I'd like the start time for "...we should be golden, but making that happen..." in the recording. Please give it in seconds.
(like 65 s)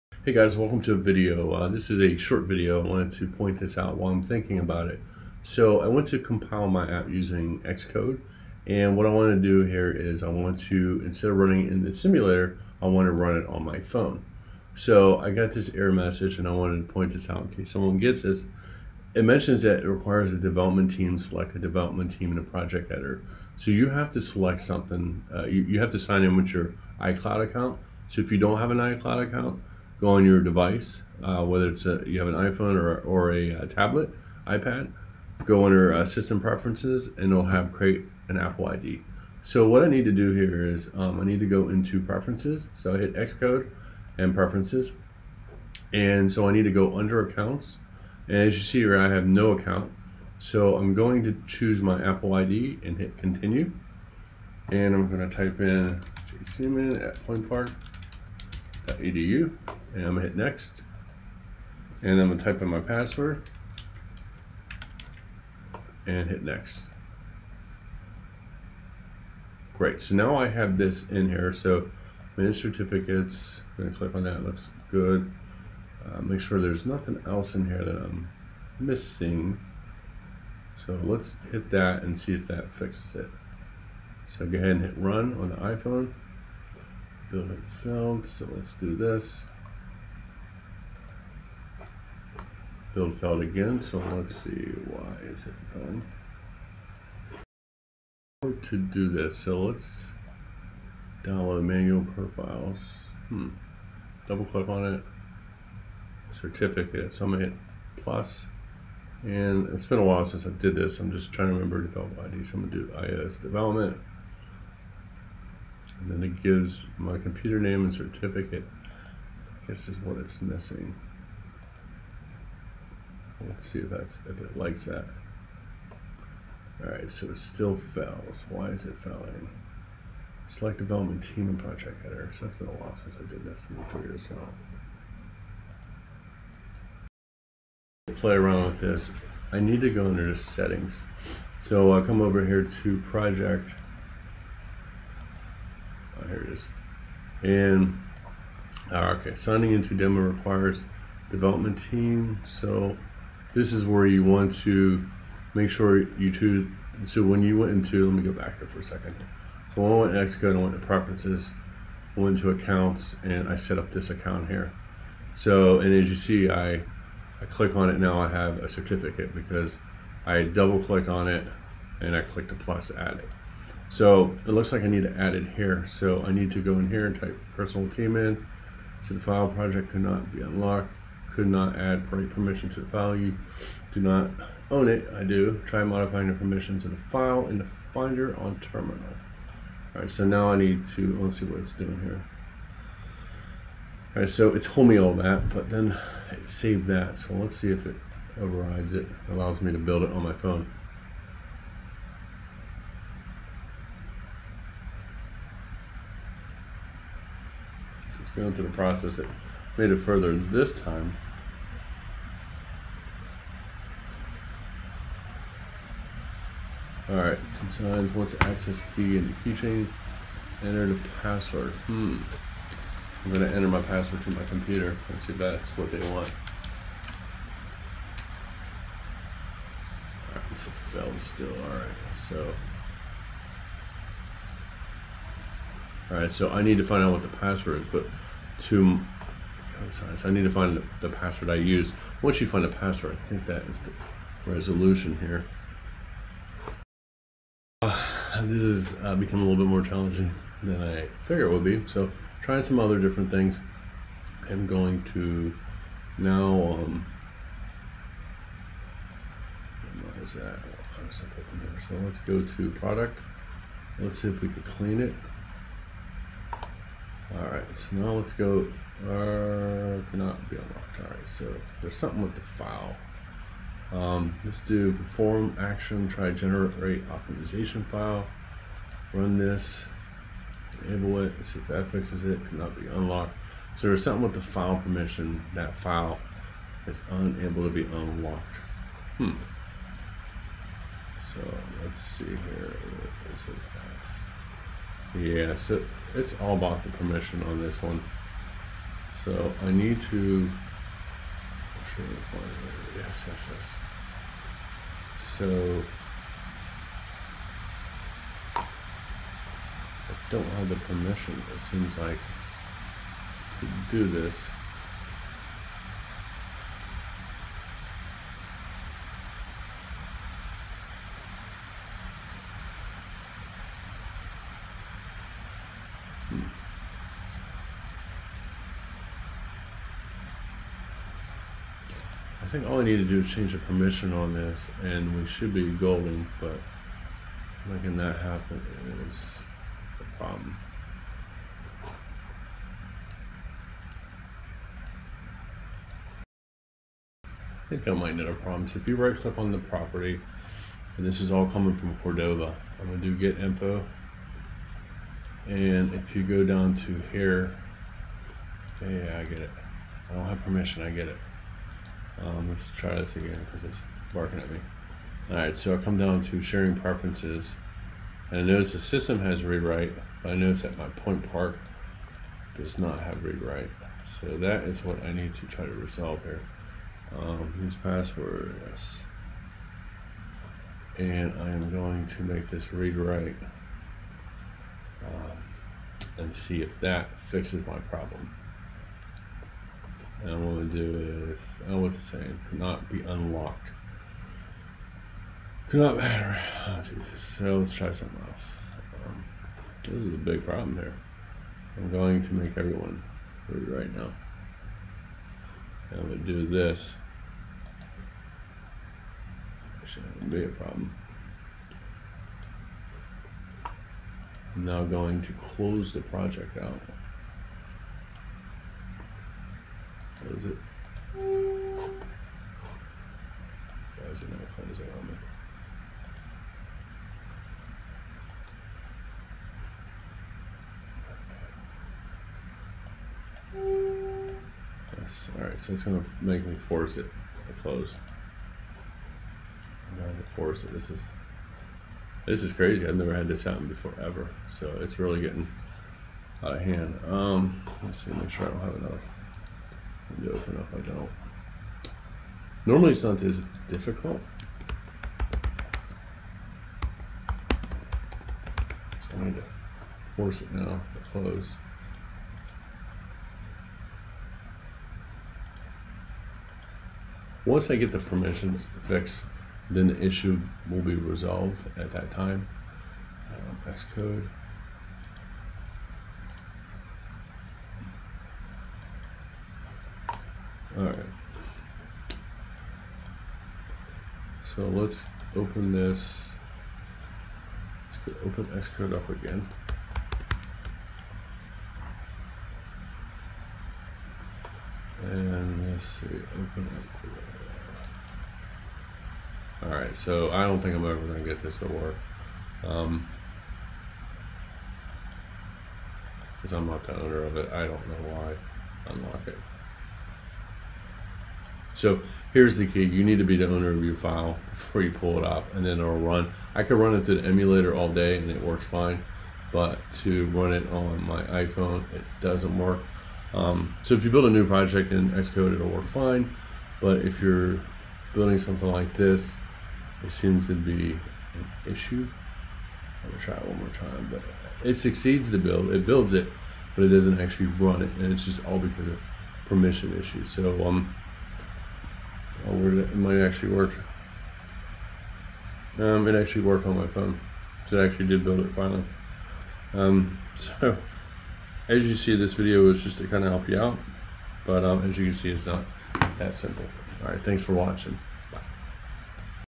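335 s.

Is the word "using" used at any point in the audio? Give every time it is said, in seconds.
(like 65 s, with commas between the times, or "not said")
7 s.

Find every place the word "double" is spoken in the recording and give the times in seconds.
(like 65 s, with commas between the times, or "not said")
104 s, 170 s.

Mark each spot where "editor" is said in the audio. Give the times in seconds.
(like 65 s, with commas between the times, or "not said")
22 s, 132 s.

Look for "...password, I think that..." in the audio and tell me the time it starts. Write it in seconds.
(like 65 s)
242 s.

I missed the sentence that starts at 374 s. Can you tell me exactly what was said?
So that is what I need to try to resolve here.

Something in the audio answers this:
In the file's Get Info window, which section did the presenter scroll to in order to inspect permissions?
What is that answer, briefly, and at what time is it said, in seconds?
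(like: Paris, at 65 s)
Sharing preferences, at 366 s.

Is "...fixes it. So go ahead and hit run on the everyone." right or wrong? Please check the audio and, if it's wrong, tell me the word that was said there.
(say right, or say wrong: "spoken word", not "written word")
wrong: "iPhone", not "everyone".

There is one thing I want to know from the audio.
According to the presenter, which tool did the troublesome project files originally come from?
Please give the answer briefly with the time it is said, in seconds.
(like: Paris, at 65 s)
Cordova, at 351 s.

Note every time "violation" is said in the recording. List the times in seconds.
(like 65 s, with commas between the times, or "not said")
not said.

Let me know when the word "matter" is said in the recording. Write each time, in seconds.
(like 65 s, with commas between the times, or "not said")
395 s.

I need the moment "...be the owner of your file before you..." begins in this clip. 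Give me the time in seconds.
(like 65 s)
513 s.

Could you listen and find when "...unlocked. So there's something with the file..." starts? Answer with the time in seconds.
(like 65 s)
282 s.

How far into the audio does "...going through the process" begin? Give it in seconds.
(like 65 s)
208 s.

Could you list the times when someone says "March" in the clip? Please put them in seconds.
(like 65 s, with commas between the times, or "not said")
not said.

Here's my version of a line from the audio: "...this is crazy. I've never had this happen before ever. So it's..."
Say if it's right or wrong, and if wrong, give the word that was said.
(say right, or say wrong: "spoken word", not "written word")
right.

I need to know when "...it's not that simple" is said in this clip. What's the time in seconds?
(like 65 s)
555 s.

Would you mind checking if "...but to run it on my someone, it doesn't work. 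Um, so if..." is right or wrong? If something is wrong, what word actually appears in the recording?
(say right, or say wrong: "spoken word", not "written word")
wrong: "iPhone", not "someone".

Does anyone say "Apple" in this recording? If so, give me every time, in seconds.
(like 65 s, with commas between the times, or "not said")
38 s, 52 s.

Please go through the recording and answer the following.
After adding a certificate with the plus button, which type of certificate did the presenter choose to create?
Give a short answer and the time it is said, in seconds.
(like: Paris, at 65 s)
iOS development, at 112 s.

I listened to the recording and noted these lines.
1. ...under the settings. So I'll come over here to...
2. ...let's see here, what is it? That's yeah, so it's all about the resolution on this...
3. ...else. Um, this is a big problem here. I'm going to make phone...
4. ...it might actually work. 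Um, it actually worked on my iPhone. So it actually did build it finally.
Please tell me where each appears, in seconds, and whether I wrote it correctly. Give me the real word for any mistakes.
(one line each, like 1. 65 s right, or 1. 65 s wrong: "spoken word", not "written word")
1. 140 s right
2. 291 s wrong: "permission", not "resolution"
3. 398 s wrong: "everyone", not "phone"
4. 542 s wrong: "phone", not "iPhone".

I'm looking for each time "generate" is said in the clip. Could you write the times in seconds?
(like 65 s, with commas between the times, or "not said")
276 s.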